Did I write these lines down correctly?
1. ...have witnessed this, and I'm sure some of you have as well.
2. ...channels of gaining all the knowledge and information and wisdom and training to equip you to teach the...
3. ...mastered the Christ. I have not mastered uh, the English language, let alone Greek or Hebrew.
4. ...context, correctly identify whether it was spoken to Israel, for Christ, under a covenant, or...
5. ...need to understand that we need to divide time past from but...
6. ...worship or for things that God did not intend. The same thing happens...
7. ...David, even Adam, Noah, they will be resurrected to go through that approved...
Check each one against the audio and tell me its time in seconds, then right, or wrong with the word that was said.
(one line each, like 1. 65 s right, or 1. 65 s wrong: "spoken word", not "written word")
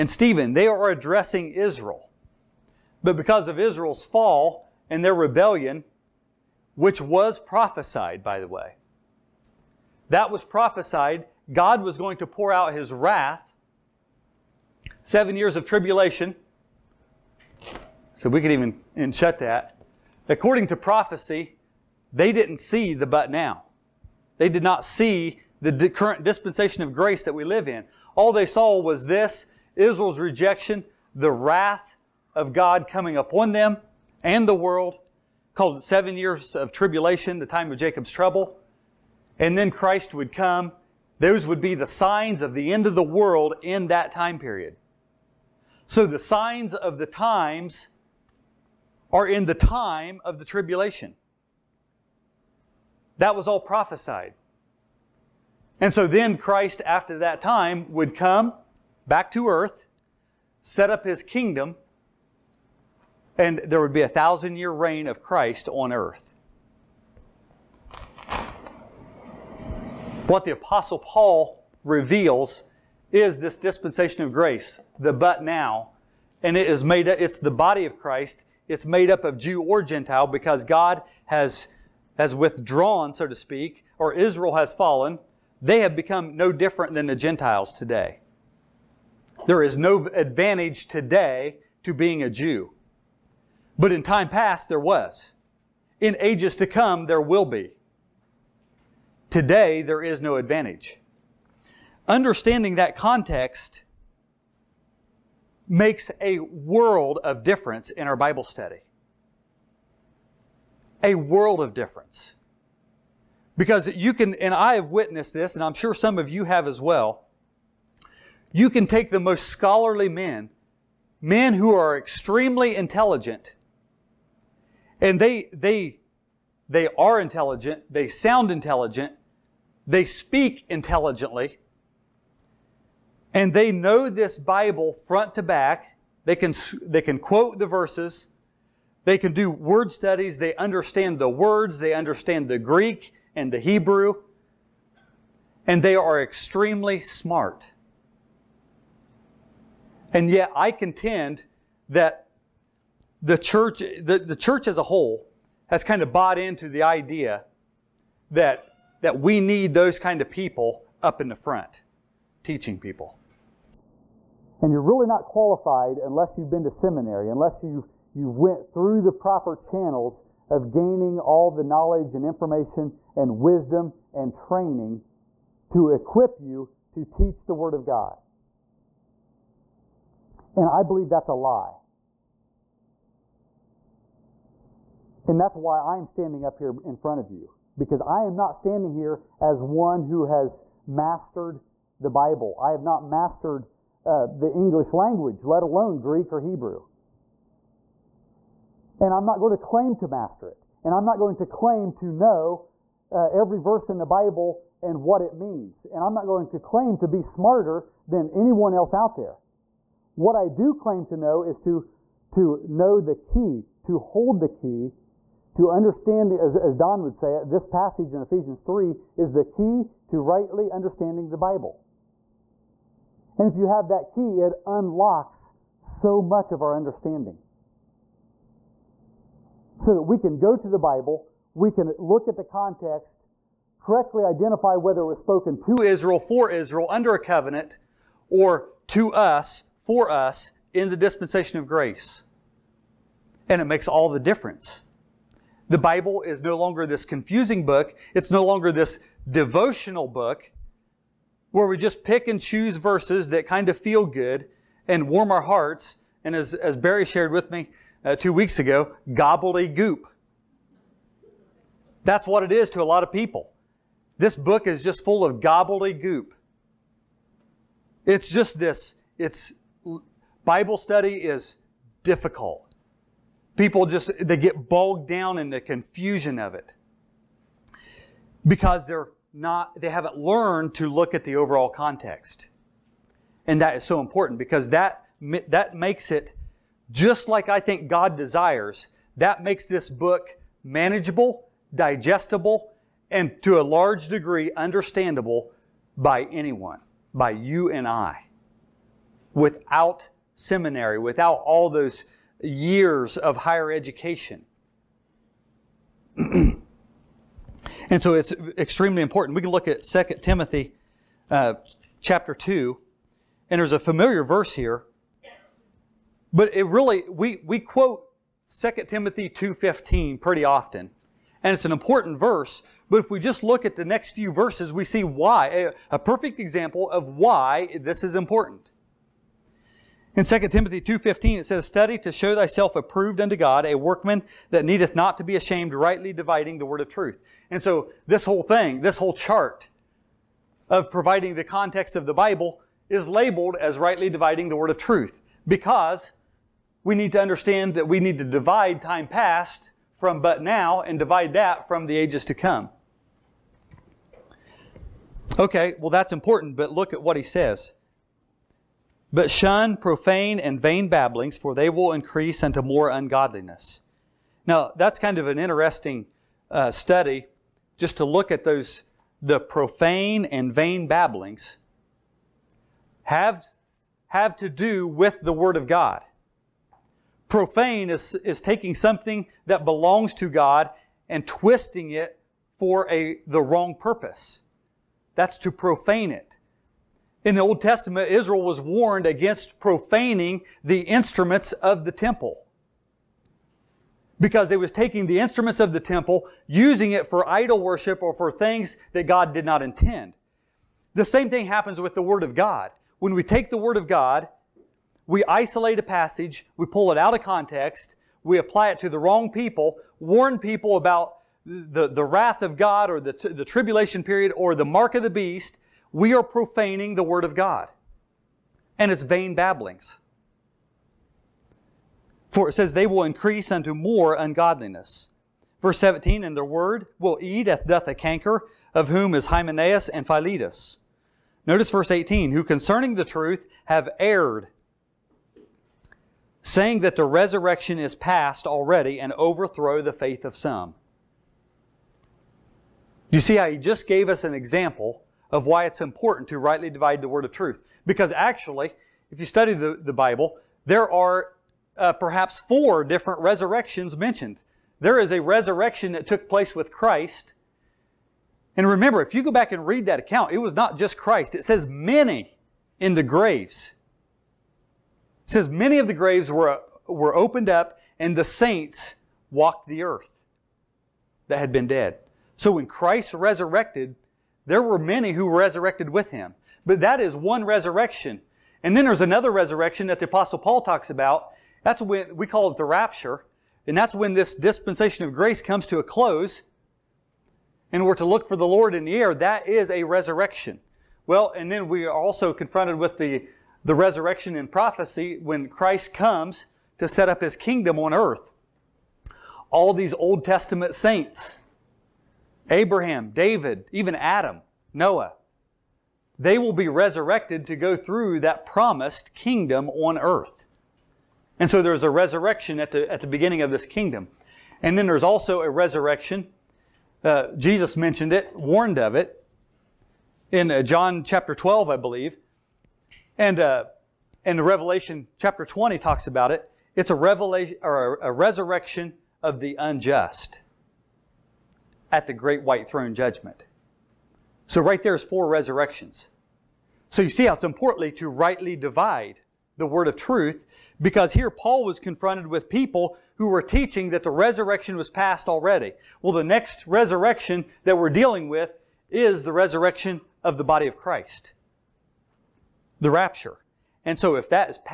1. 114 s right
2. 169 s right
3. 190 s wrong: "Bible", not "Christ"
4. 232 s wrong: "Israel", not "Christ"
5. 346 s right
6. 397 s right
7. 503 s wrong: "promised", not "approved".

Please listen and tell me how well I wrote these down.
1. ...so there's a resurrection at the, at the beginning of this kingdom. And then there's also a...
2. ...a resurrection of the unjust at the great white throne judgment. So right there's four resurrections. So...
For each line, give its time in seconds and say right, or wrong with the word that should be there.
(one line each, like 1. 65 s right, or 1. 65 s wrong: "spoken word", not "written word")
1. 511 s right
2. 528 s right.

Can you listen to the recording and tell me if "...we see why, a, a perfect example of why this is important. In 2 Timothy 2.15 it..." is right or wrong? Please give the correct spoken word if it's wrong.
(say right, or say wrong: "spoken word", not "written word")
right.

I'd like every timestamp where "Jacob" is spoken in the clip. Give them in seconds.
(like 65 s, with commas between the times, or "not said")
37 s.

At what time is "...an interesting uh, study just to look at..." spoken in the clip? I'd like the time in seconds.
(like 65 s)
365 s.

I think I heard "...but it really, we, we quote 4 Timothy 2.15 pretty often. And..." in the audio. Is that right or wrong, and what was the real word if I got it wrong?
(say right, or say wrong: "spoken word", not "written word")
wrong: "2", not "4".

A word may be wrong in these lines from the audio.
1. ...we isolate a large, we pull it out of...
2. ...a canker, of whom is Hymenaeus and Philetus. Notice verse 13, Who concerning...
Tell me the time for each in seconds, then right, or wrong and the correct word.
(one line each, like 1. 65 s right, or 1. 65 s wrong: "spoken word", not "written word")
1. 405 s wrong: "passage", not "large"
2. 427 s wrong: "18", not "13".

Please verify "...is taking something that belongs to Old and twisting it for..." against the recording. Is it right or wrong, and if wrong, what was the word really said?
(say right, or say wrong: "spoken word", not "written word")
wrong: "God", not "Old".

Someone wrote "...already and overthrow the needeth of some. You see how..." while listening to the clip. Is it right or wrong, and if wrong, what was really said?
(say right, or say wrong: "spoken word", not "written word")
wrong: "faith", not "needeth".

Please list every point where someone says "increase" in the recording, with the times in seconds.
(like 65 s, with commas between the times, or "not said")
361 s, 423 s.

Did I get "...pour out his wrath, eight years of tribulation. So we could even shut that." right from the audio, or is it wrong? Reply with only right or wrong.
wrong.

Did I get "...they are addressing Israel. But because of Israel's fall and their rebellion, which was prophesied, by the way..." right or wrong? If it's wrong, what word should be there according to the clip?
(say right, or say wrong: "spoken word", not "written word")
right.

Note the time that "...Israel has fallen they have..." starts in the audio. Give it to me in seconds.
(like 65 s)
84 s.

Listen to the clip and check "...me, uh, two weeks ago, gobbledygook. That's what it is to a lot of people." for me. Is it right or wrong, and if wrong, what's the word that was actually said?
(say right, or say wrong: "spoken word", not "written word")
right.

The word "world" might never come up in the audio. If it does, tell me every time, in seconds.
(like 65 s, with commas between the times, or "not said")
34 s, 43 s, 106 s, 111 s.